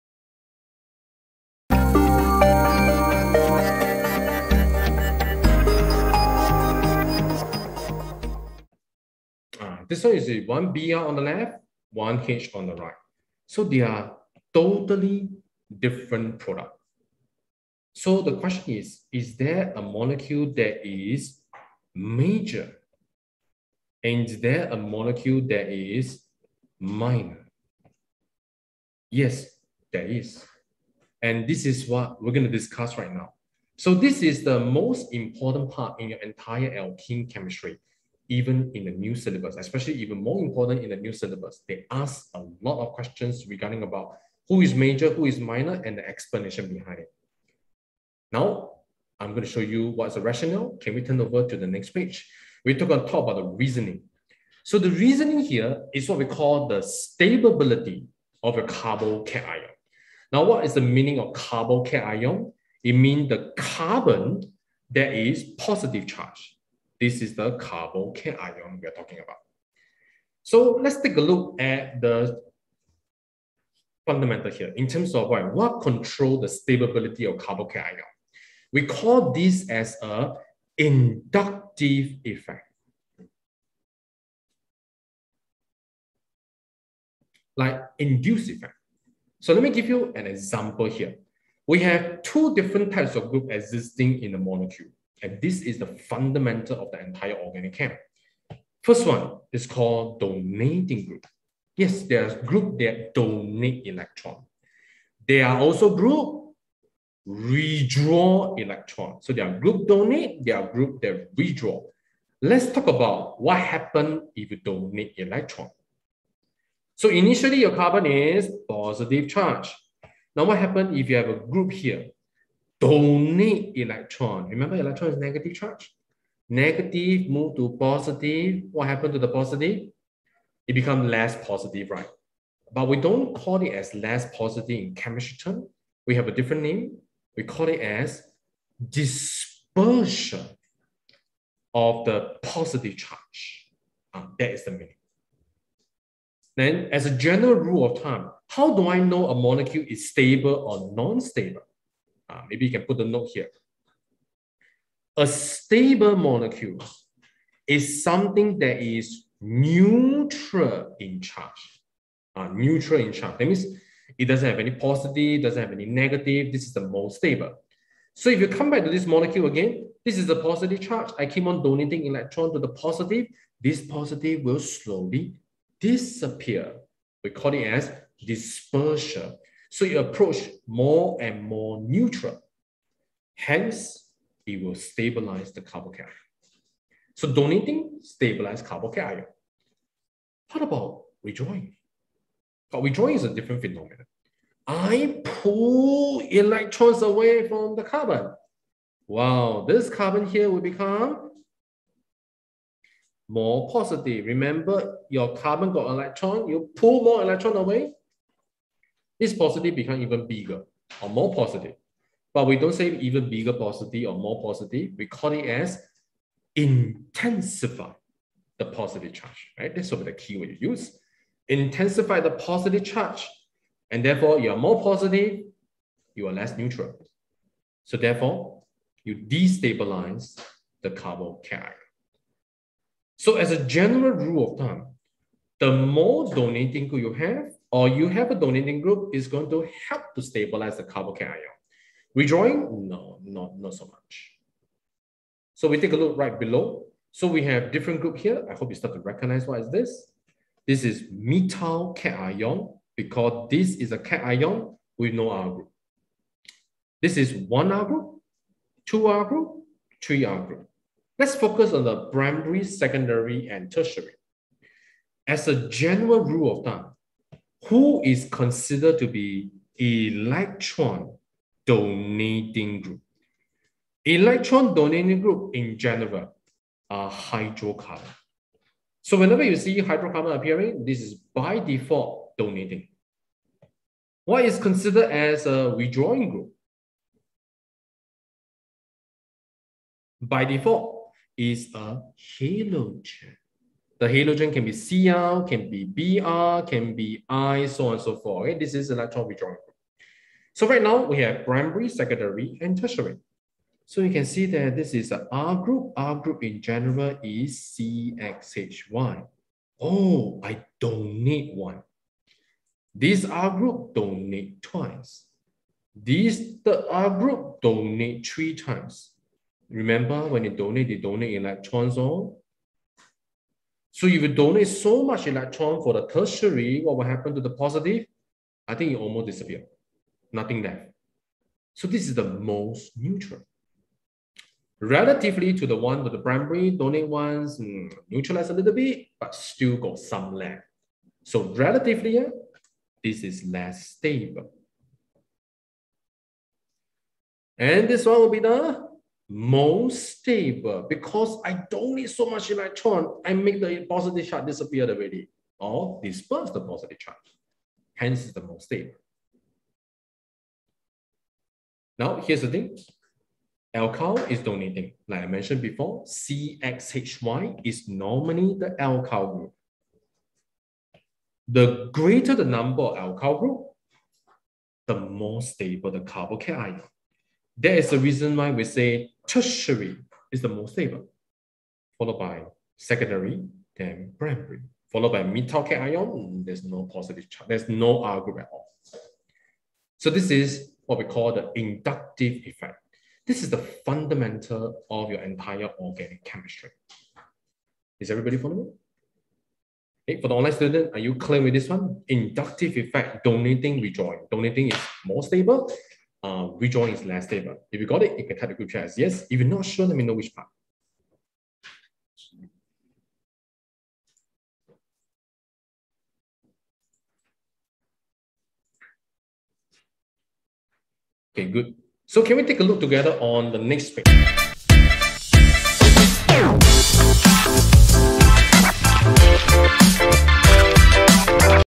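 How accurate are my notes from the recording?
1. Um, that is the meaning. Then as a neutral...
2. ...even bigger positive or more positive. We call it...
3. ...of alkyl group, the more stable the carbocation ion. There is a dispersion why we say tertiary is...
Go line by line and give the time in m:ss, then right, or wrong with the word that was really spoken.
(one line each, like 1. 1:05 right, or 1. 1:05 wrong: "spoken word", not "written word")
1. 2:24 wrong: "general", not "neutral"
2. 3:32 right
3. 6:12 wrong: "reason", not "dispersion".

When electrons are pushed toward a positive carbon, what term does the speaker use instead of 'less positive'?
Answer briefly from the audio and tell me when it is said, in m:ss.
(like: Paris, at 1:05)
dispersion of the positive charge, at 2:18.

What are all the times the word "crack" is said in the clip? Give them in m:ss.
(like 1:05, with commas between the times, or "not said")
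not said.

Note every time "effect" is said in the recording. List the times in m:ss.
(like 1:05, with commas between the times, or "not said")
1:22, 1:28, 6:32, 6:42.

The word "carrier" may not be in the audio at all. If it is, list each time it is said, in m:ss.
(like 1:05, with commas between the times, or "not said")
3:51.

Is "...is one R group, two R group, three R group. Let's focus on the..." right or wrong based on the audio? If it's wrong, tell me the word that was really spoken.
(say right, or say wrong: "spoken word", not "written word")
right.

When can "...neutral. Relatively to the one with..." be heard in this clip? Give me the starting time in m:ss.
5:32.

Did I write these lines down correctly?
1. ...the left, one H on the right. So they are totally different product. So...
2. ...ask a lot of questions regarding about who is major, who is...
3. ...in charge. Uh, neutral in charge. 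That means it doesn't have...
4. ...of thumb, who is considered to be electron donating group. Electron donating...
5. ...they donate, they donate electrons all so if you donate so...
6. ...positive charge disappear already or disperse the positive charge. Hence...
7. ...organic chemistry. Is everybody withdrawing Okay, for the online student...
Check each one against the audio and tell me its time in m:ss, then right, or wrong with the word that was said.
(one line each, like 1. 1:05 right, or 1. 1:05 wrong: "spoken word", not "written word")
1. 0:11 right
2. 0:41 right
3. 2:40 right
4. 4:26 right
5. 5:20 right
6. 5:53 right
7. 6:35 wrong: "following", not "withdrawing".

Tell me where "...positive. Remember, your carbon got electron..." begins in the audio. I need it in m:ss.
3:23.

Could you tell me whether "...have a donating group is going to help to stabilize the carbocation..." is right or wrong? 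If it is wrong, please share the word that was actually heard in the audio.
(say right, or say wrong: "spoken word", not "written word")
right.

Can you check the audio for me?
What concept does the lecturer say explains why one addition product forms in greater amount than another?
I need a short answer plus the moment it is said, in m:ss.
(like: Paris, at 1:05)
stability of a carbocation, at 0:56.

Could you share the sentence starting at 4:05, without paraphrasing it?
So we take a look right below.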